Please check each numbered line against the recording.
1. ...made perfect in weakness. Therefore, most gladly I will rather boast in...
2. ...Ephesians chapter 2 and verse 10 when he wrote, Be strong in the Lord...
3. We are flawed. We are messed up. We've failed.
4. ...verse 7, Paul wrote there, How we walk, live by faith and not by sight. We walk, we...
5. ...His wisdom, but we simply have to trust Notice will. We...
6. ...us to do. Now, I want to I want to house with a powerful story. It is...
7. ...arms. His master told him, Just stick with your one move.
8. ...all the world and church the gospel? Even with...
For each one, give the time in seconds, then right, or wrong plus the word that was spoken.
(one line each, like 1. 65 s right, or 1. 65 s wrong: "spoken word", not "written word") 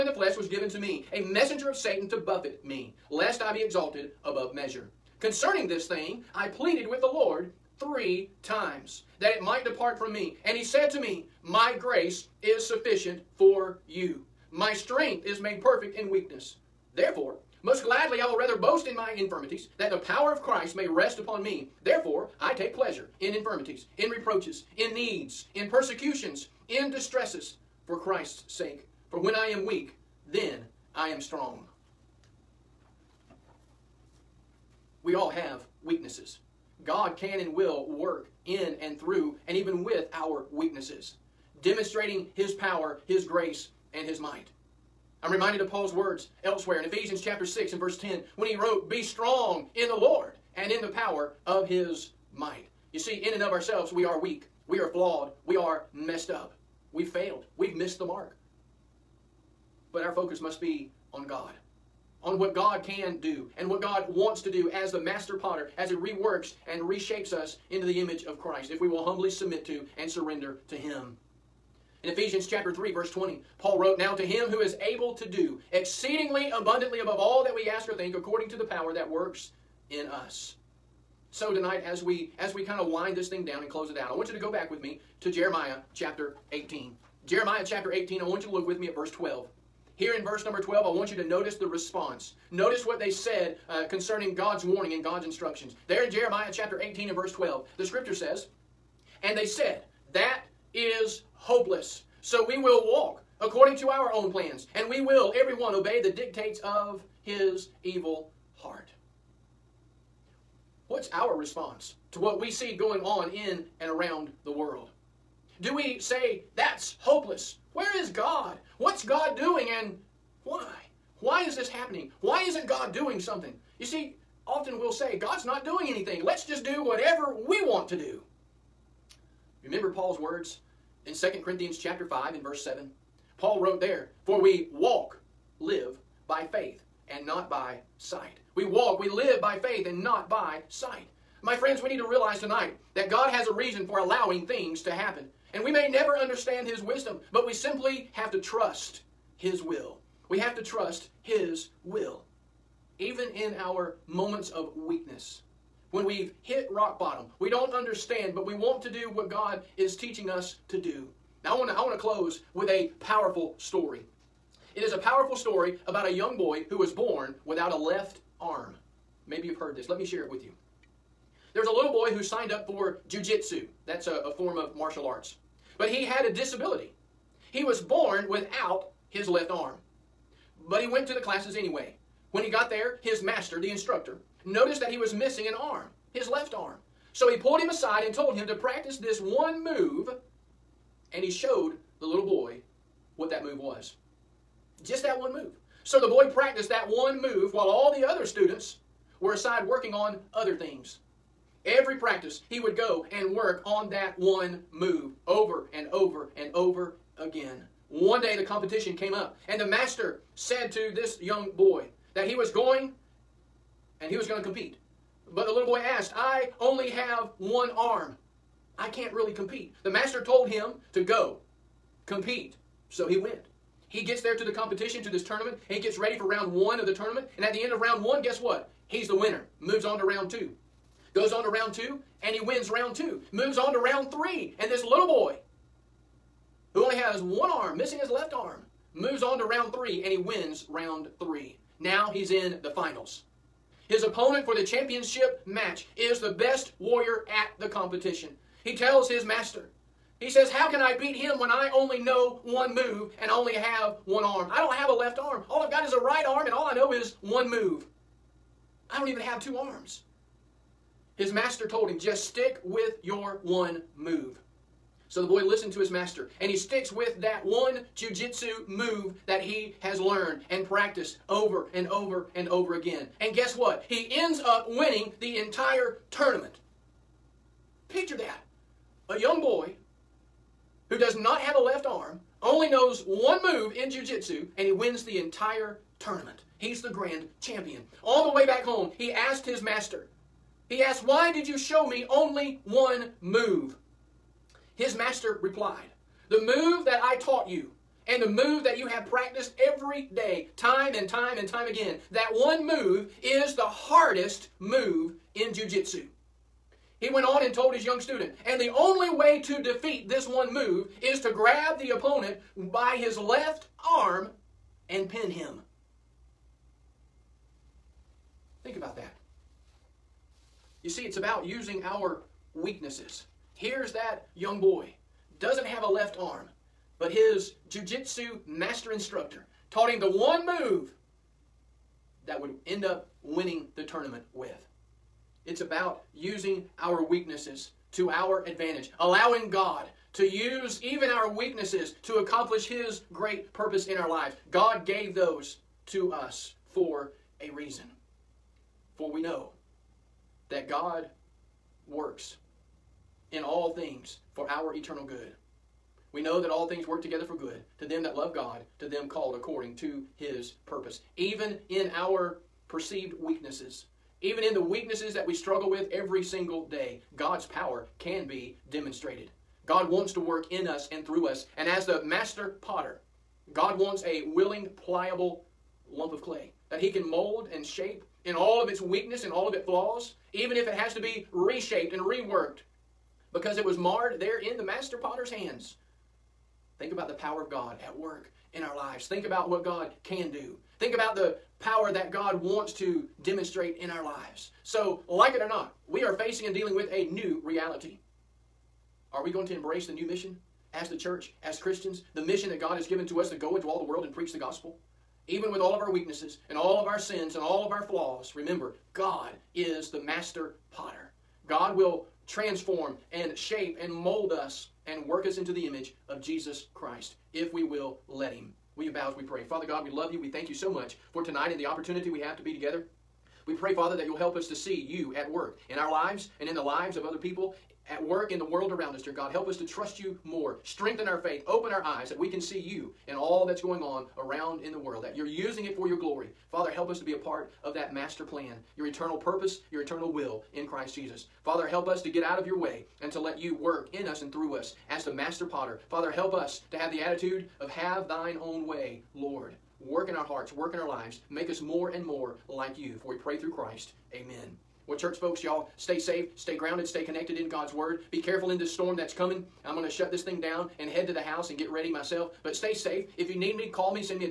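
1. 15 s right
2. 46 s wrong: "6", not "2"
3. 54 s right
4. 132 s wrong: "For", not "How"
5. 146 s wrong: "His", not "Notice"
6. 160 s wrong: "close", not "house"
7. 259 s right
8. 403 s wrong: "preach", not "church".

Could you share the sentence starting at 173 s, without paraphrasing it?
That's a, a form of martial arts.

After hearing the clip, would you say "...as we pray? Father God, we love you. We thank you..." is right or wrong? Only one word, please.
right.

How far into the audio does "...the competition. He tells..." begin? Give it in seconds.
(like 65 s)
247 s.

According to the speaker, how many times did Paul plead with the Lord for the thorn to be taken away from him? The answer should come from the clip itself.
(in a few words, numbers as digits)
3.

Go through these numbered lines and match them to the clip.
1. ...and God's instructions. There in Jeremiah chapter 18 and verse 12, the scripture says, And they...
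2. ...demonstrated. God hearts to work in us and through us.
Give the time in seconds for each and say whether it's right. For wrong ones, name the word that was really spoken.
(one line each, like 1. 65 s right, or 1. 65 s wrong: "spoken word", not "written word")
1. 94 s right
2. 368 s wrong: "wants", not "hearts".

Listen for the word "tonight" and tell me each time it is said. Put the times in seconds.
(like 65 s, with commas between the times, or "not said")
81 s, 142 s, 421 s.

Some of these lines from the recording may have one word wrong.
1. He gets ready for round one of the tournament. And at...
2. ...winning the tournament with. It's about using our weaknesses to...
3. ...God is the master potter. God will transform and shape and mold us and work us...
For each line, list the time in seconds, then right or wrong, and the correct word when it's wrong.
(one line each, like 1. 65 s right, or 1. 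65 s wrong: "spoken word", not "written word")
1. 225 s right
2. 333 s right
3. 408 s right.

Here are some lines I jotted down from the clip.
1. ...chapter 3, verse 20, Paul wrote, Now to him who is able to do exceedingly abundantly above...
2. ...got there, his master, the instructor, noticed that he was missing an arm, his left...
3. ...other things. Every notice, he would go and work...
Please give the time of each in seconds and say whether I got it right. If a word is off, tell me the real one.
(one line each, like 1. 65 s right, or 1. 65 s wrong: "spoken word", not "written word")
1. 72 s right
2. 182 s right
3. 200 s wrong: "practice", not "notice".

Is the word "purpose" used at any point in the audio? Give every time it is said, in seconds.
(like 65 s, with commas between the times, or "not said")
343 s, 360 s, 439 s.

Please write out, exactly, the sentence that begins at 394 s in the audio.
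So, like it or not, we are facing and dealing with a new reality.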